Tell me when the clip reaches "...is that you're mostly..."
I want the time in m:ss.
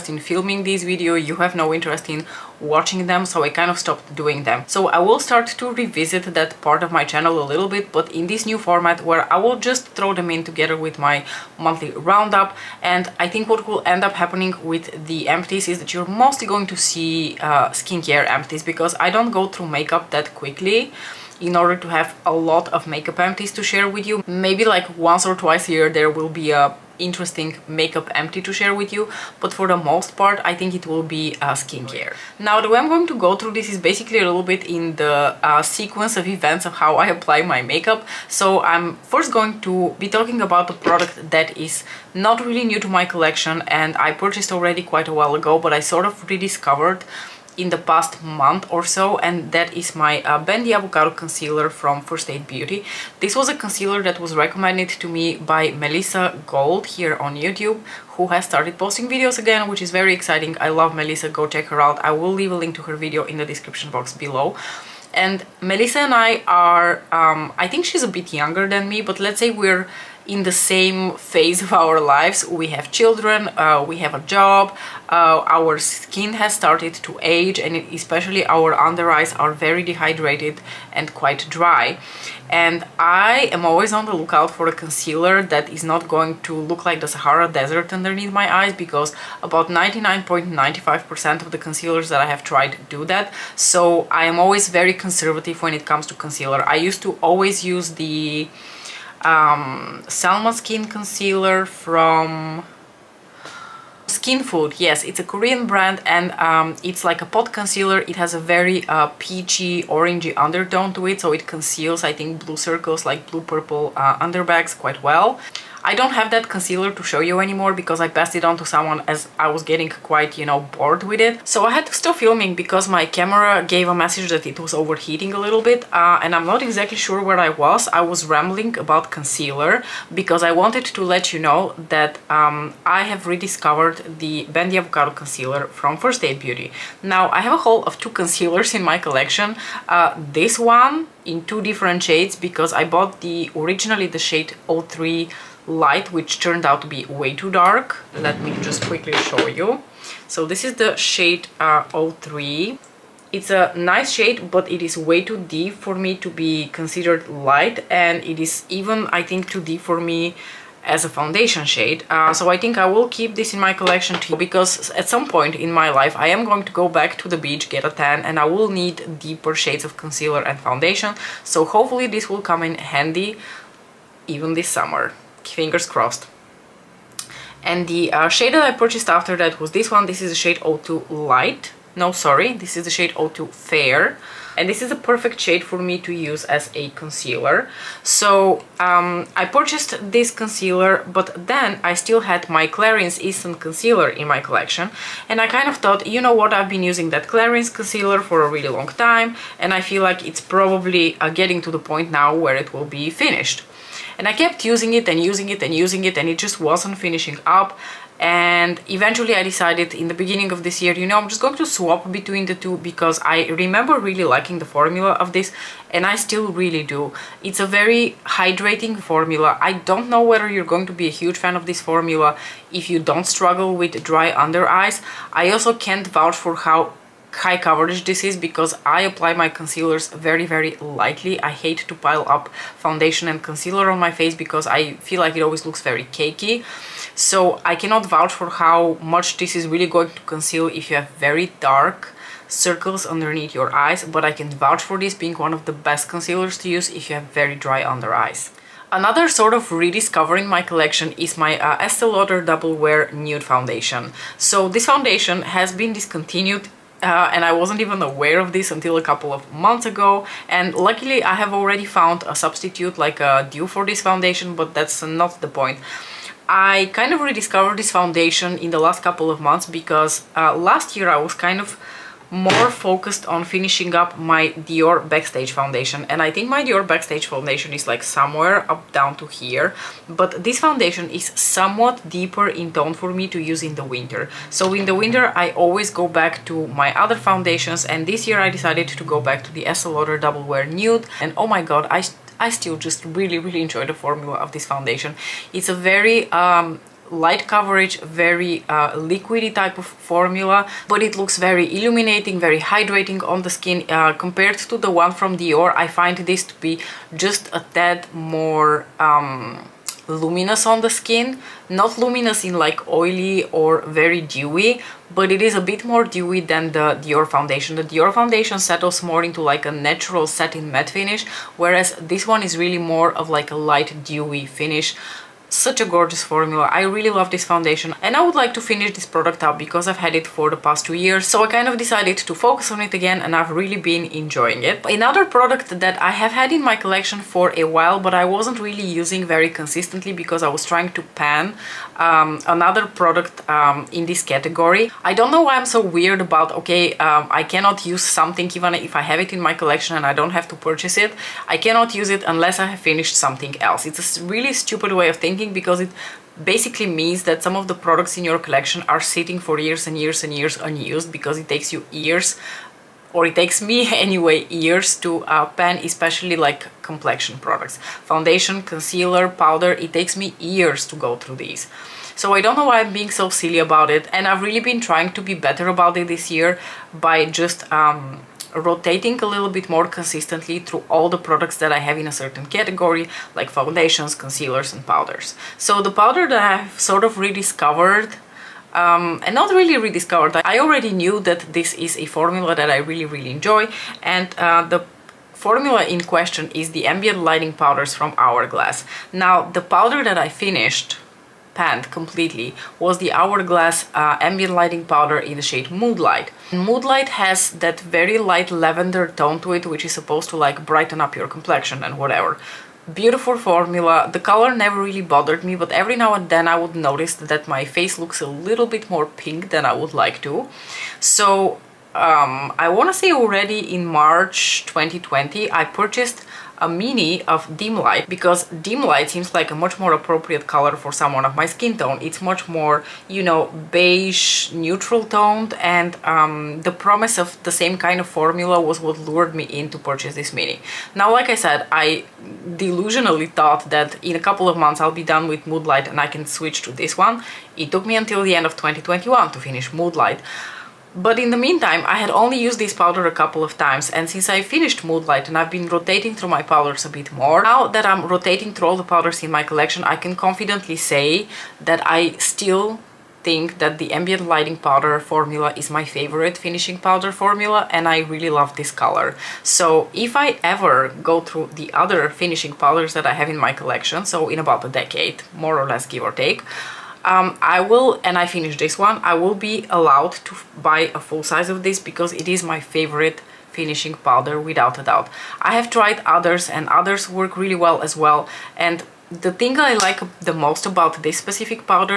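0:15.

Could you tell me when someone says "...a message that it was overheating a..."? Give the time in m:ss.
2:03.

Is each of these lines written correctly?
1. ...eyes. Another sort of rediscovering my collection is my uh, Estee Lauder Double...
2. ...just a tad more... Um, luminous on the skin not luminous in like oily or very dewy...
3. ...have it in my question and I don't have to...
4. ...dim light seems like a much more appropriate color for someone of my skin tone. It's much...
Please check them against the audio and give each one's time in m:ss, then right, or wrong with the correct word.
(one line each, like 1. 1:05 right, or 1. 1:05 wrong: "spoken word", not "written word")
1. 4:08 right
2. 5:07 right
3. 5:49 wrong: "collection", not "question"
4. 7:08 right.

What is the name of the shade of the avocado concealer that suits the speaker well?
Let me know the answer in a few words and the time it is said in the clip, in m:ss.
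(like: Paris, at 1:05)
02 Fair, at 3:03.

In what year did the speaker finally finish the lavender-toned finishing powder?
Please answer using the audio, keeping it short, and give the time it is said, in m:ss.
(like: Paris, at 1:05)
2021, at 7:28.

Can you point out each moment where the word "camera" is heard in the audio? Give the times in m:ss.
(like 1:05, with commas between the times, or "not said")
2:03.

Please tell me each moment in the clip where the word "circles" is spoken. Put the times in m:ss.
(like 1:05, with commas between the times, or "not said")
1:52, 4:02.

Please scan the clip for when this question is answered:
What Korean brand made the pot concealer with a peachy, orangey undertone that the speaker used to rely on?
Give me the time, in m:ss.
1:44.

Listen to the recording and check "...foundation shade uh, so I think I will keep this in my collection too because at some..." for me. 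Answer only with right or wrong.
right.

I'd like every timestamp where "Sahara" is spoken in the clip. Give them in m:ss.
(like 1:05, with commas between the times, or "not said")
1:27.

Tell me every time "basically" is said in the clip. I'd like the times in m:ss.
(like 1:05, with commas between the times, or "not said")
0:33, 5:56.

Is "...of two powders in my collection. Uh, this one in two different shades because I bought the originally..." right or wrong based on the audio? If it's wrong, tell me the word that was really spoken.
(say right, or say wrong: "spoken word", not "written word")
wrong: "concealers", not "powders".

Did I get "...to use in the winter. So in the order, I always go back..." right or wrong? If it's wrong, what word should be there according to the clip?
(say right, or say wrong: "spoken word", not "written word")
wrong: "winter", not "order".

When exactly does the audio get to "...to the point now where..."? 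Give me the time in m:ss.
3:21.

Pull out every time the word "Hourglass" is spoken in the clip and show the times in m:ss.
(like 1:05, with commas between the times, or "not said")
6:38, 6:43.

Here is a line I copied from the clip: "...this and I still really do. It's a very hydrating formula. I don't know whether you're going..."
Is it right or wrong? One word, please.
right.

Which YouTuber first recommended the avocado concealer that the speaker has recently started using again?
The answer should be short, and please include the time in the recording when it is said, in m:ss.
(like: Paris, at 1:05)
Melissa Gold, at 0:55.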